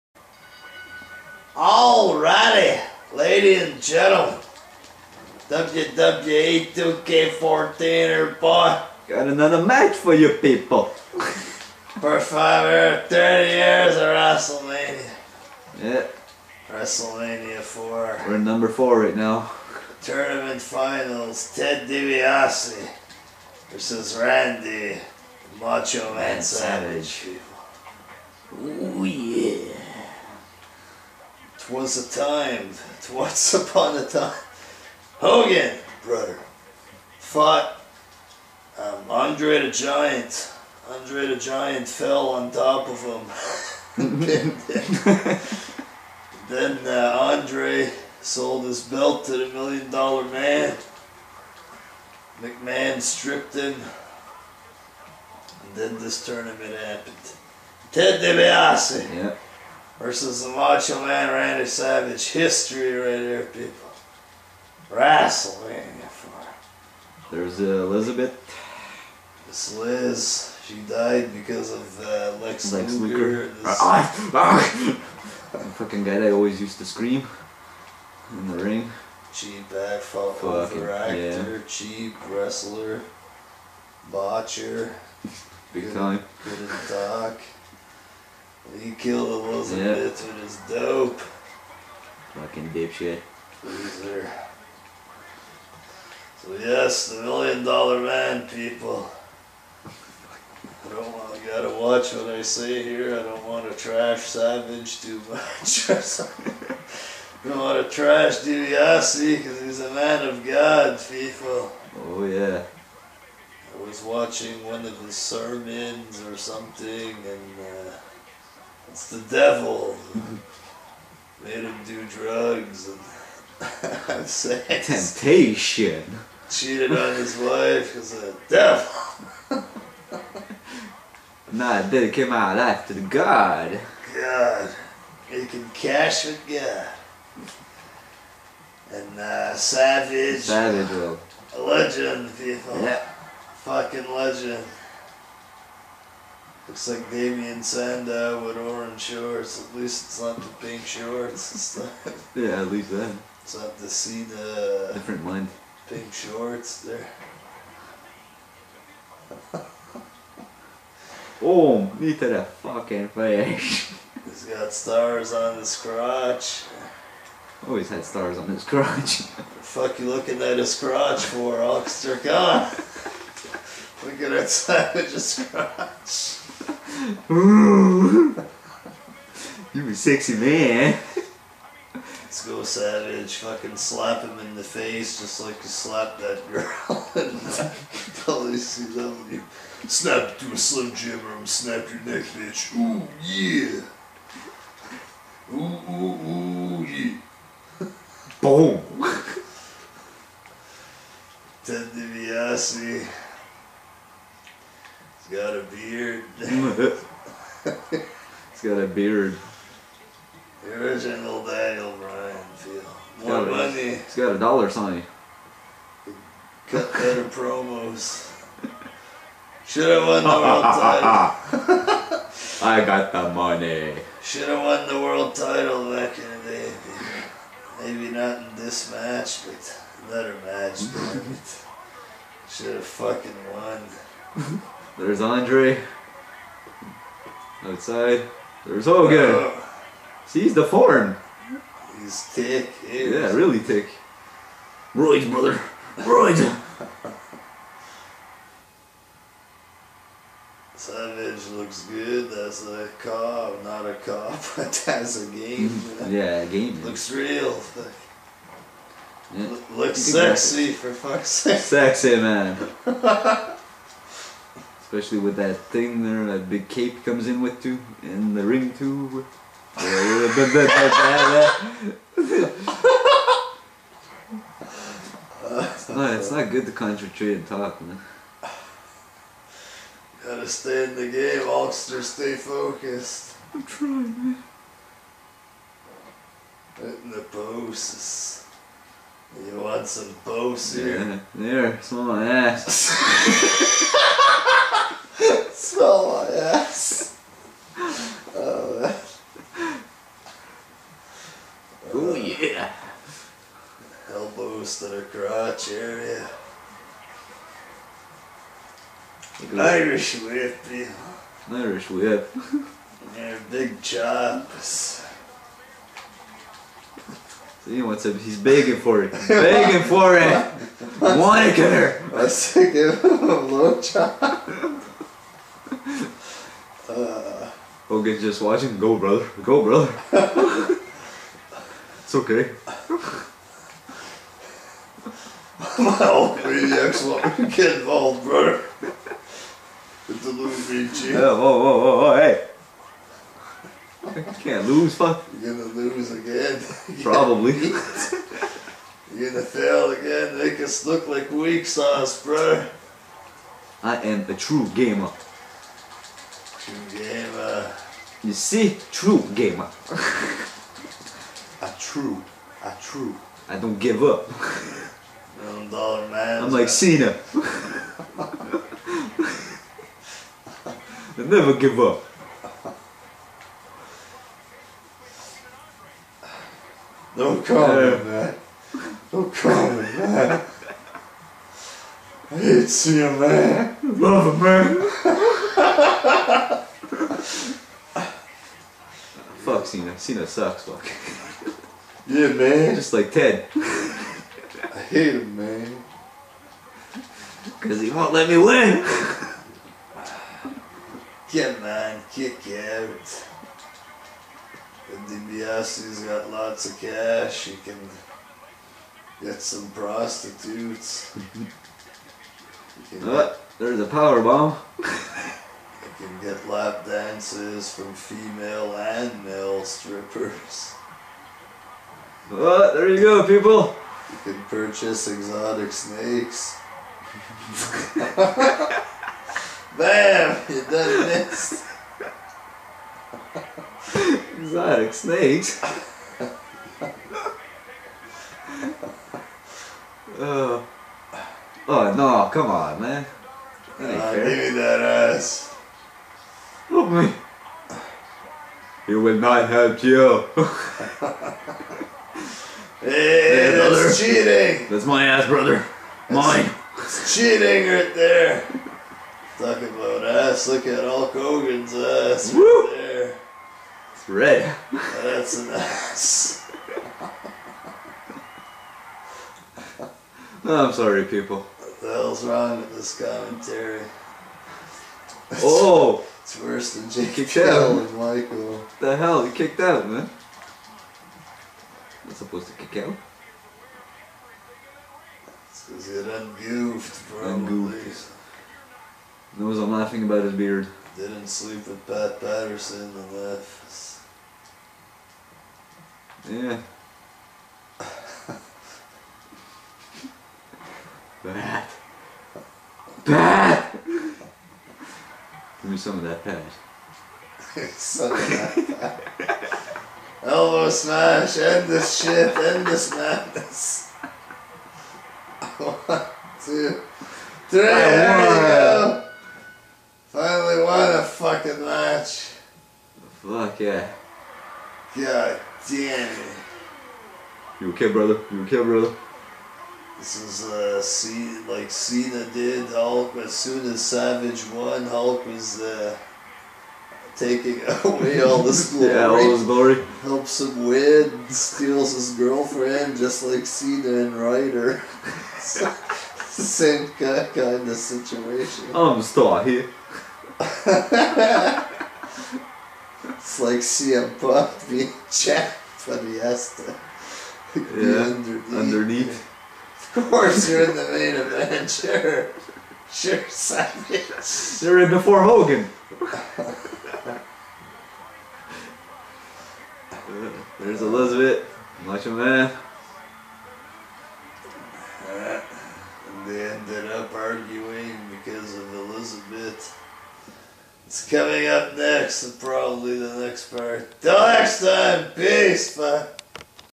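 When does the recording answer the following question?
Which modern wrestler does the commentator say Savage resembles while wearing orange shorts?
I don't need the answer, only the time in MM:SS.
02:27.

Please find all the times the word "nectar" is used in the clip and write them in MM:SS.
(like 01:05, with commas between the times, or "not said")
not said.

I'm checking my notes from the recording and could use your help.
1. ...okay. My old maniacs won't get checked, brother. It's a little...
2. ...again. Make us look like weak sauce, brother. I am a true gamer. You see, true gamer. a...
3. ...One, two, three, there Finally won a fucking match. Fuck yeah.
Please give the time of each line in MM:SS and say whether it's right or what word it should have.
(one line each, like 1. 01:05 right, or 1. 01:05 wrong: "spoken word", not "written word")
1. 05:32 wrong: "involved", not "checked"
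2. 05:49 right
3. 08:35 right.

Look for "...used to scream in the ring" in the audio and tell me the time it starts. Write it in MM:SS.
01:16.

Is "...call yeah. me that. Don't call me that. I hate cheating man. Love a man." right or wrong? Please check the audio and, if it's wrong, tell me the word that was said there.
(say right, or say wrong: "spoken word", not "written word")
wrong: "seeing", not "cheating".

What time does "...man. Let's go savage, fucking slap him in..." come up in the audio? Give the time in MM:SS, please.
03:00.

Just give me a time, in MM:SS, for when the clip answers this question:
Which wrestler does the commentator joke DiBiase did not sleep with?
08:11.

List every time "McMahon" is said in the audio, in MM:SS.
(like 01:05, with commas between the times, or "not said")
00:52.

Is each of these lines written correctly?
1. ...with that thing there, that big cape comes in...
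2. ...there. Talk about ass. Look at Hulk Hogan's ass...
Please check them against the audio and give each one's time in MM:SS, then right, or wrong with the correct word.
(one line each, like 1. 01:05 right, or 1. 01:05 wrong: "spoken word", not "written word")
1. 04:25 right
2. 07:37 right.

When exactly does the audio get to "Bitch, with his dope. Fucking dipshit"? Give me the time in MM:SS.
01:30.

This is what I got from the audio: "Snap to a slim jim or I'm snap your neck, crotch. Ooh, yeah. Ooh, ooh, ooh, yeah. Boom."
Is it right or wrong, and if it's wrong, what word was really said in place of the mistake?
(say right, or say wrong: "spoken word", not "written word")
wrong: "bitch", not "crotch".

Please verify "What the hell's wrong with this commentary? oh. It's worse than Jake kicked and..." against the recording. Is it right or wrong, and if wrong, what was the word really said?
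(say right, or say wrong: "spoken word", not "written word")
right.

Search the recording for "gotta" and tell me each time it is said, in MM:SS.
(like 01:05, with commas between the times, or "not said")
01:41, 04:40.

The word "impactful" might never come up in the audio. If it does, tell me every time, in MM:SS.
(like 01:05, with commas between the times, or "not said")
not said.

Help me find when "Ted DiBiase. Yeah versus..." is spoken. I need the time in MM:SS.
00:57.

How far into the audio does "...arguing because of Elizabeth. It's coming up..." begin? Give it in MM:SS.
09:37.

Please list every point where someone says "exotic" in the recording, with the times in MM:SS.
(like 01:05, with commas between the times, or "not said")
07:05, 07:14.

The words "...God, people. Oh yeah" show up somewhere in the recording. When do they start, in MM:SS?
01:50.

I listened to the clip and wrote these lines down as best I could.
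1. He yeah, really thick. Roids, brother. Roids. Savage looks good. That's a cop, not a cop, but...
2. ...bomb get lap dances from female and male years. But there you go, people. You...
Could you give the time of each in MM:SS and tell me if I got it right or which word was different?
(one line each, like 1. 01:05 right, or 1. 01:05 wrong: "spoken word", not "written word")
1. 04:02 right
2. 06:54 wrong: "strippers", not "years".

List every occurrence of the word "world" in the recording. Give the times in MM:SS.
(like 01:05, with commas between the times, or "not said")
03:40, 03:45.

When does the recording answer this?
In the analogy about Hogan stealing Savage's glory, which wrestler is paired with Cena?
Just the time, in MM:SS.
09:04.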